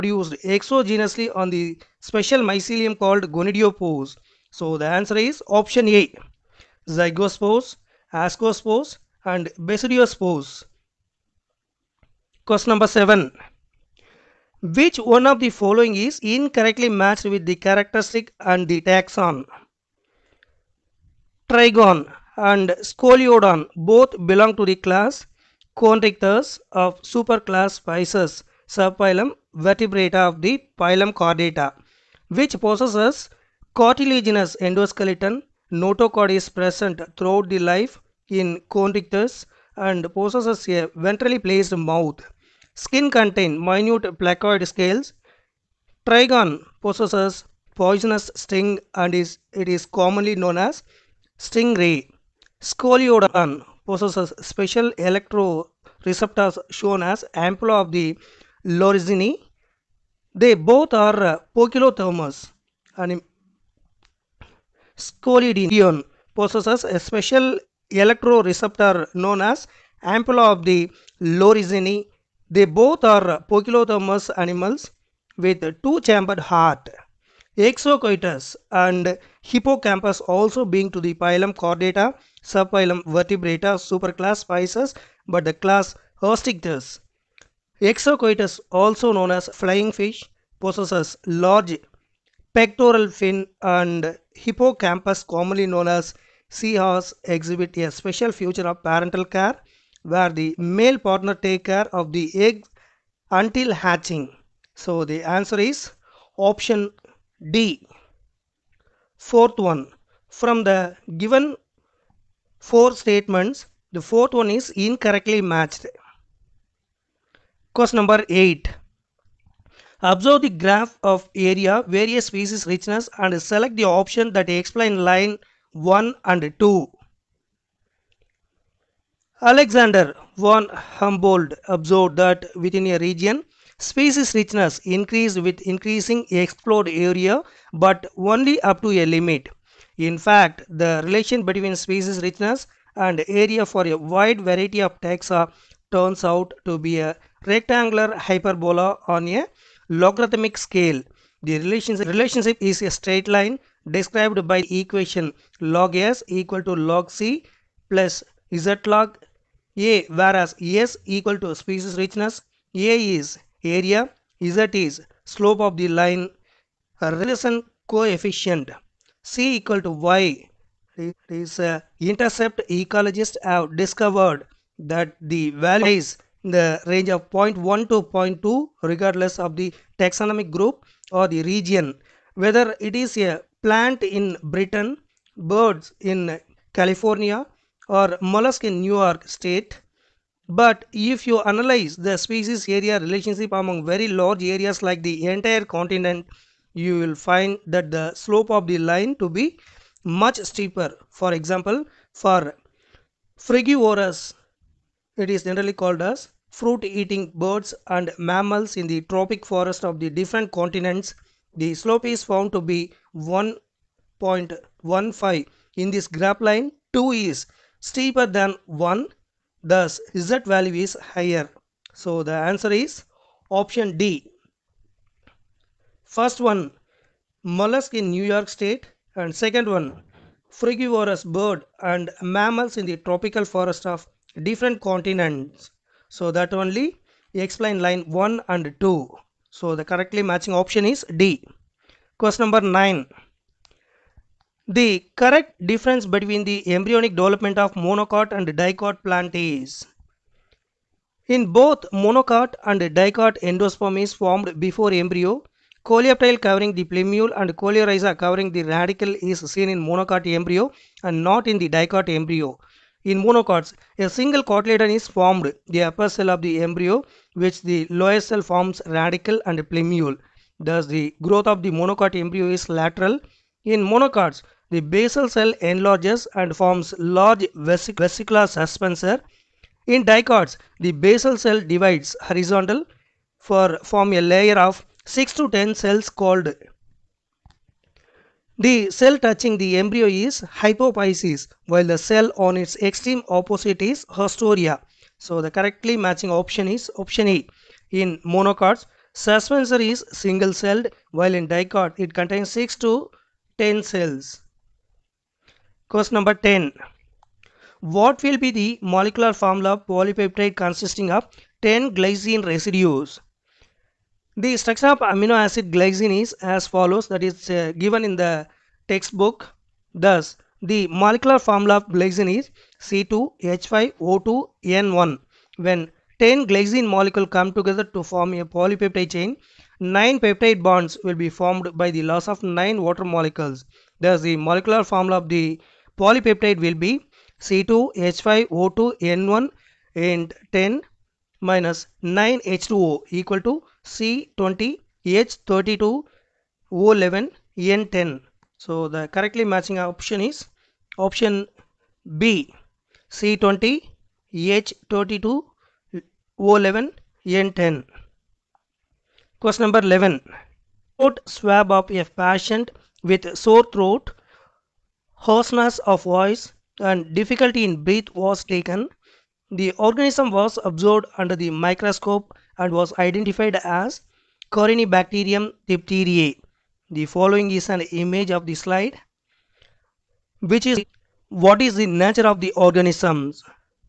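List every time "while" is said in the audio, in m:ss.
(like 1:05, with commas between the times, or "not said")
4:51, 5:01.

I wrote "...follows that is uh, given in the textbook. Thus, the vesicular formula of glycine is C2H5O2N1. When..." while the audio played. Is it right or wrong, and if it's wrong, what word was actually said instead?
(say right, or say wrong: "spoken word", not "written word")
wrong: "molecular", not "vesicular".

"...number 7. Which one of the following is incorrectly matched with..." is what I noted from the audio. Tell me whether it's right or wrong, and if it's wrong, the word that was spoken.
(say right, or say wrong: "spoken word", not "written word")
right.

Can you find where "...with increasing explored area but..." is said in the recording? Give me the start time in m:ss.
2:15.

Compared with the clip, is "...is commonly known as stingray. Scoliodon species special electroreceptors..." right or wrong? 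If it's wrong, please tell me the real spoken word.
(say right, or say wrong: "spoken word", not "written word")
wrong: "possesses", not "species".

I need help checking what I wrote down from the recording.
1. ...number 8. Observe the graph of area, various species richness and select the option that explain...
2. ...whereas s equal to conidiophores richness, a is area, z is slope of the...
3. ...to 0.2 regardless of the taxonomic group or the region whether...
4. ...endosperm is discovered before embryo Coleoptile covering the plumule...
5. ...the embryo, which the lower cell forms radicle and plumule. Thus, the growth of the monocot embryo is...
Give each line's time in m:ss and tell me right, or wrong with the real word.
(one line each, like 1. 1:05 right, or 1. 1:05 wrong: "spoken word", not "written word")
1. 1:57 right
2. 2:40 wrong: "species", not "conidiophores"
3. 2:57 right
4. 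4:13 wrong: "formed", not "discovered"
5. 4:26 right.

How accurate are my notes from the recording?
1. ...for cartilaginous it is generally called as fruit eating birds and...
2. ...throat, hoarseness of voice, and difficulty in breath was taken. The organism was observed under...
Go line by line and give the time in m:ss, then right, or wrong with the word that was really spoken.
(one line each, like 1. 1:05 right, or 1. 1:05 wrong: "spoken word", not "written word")
1. 3:22 wrong: "frugivorous", not "cartilaginous"
2. 6:03 right.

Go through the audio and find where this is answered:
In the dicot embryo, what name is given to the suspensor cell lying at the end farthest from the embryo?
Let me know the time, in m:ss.
4:54.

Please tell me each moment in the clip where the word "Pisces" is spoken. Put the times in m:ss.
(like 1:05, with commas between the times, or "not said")
0:27, 1:24.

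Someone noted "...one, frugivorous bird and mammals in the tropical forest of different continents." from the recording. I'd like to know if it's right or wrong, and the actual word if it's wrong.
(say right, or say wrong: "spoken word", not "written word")
right.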